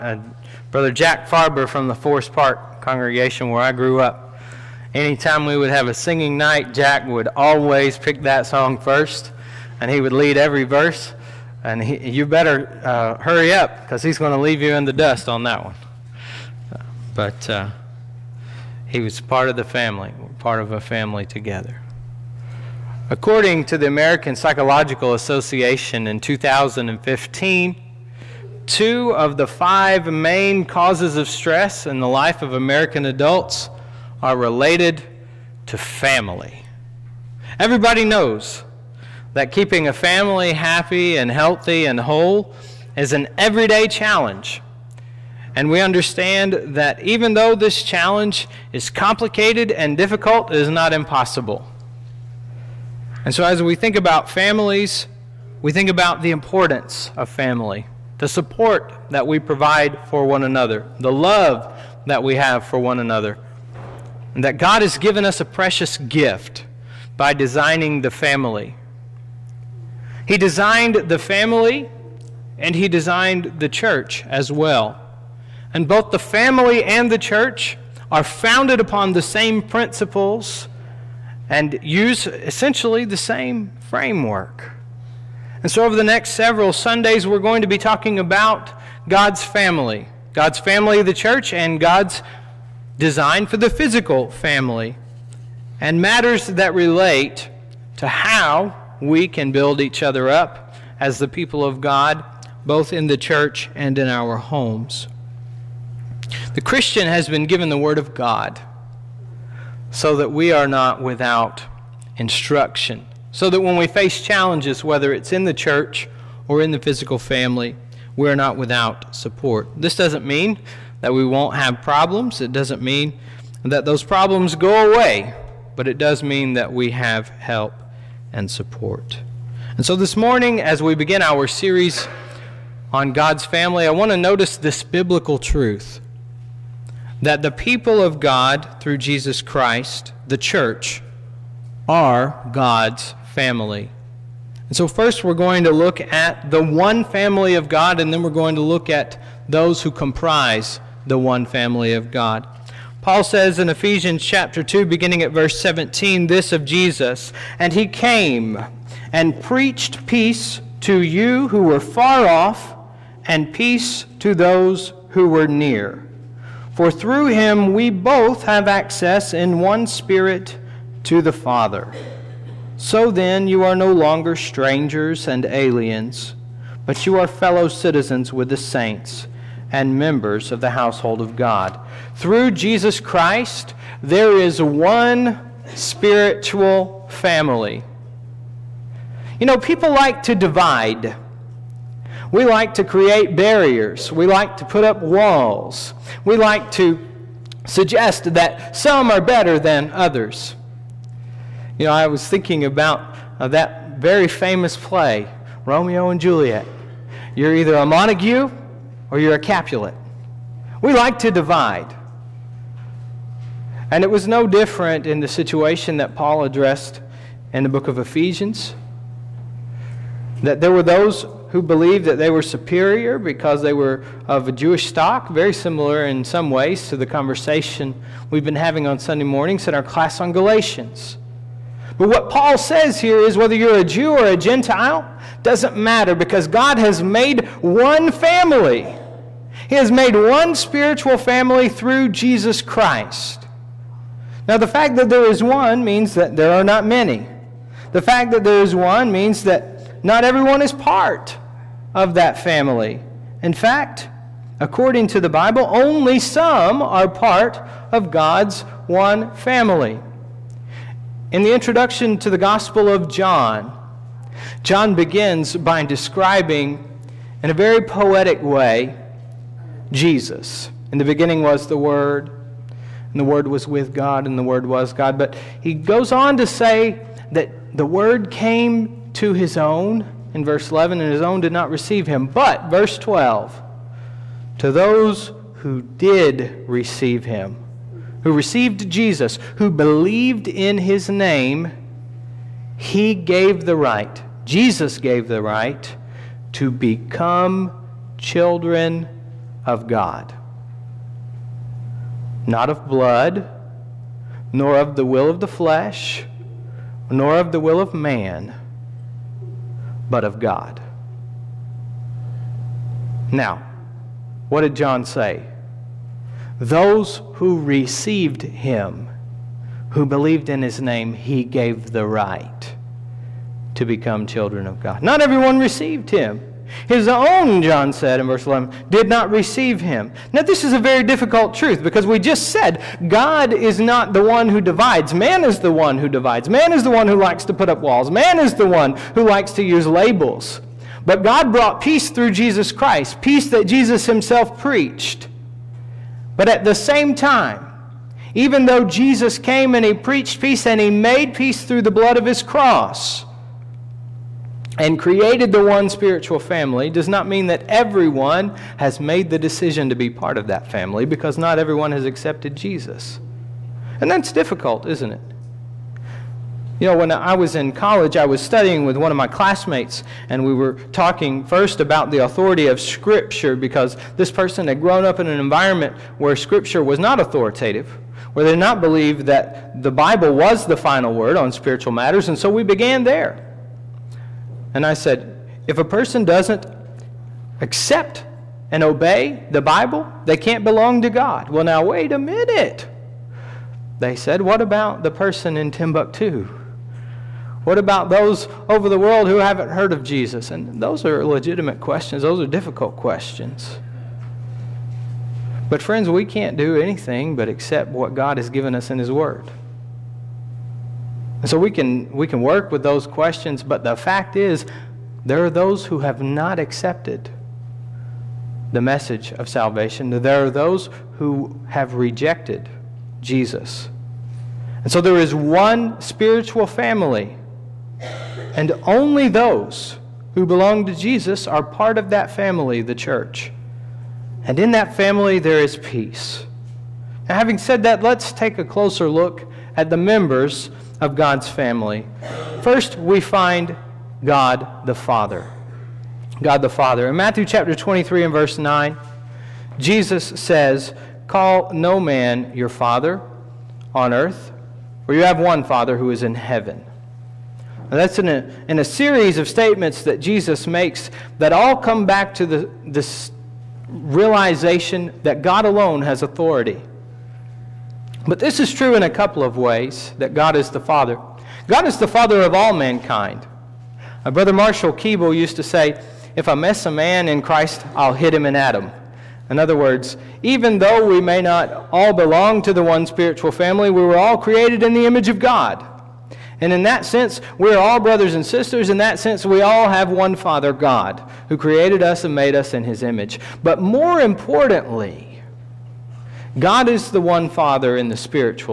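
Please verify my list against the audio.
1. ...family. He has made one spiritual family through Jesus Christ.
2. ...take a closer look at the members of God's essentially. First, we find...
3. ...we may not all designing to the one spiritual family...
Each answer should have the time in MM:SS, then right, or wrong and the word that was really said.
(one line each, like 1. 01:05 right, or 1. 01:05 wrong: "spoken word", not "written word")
1. 03:58 right
2. 07:18 wrong: "family", not "essentially"
3. 08:01 wrong: "belong", not "designing".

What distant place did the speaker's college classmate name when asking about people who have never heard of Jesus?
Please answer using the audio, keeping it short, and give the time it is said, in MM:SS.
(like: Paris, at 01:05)
Timbuktu, at 06:35.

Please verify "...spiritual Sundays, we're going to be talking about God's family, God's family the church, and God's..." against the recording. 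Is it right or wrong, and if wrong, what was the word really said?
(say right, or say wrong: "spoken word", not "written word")
wrong: "several", not "spiritual".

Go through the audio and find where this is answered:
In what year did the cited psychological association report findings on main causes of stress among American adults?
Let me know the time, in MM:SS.
00:26.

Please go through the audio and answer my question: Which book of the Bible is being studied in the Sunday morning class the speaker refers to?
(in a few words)
Galatians.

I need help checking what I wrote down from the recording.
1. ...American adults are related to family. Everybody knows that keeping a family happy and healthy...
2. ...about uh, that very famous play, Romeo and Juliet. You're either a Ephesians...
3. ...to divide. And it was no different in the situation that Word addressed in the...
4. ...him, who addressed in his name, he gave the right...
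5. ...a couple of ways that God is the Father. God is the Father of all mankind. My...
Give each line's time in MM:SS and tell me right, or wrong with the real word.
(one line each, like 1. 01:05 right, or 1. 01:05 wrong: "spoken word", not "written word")
1. 00:32 right
2. 03:22 wrong: "Montague", not "Ephesians"
3. 03:31 wrong: "Paul", not "Word"
4. 05:18 wrong: "believed", not "addressed"
5. 07:49 right.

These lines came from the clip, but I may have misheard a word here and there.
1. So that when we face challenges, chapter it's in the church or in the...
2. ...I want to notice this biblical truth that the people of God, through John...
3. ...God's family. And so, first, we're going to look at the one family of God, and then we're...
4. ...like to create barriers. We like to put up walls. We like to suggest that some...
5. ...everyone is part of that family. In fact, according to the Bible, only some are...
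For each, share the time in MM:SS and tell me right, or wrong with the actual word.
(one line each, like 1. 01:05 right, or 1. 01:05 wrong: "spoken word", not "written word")
1. 01:53 wrong: "whether", not "chapter"
2. 02:13 wrong: "Jesus", not "John"
3. 02:22 right
4. 03:12 right
5. 04:10 right.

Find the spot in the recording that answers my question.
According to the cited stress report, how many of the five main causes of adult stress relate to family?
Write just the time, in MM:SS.
00:28.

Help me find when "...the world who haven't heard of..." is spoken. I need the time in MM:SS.
06:38.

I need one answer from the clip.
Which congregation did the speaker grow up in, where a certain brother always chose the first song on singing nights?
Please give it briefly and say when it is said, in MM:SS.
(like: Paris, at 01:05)
Forest Park, at 00:01.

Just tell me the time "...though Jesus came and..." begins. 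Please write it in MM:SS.
05:48.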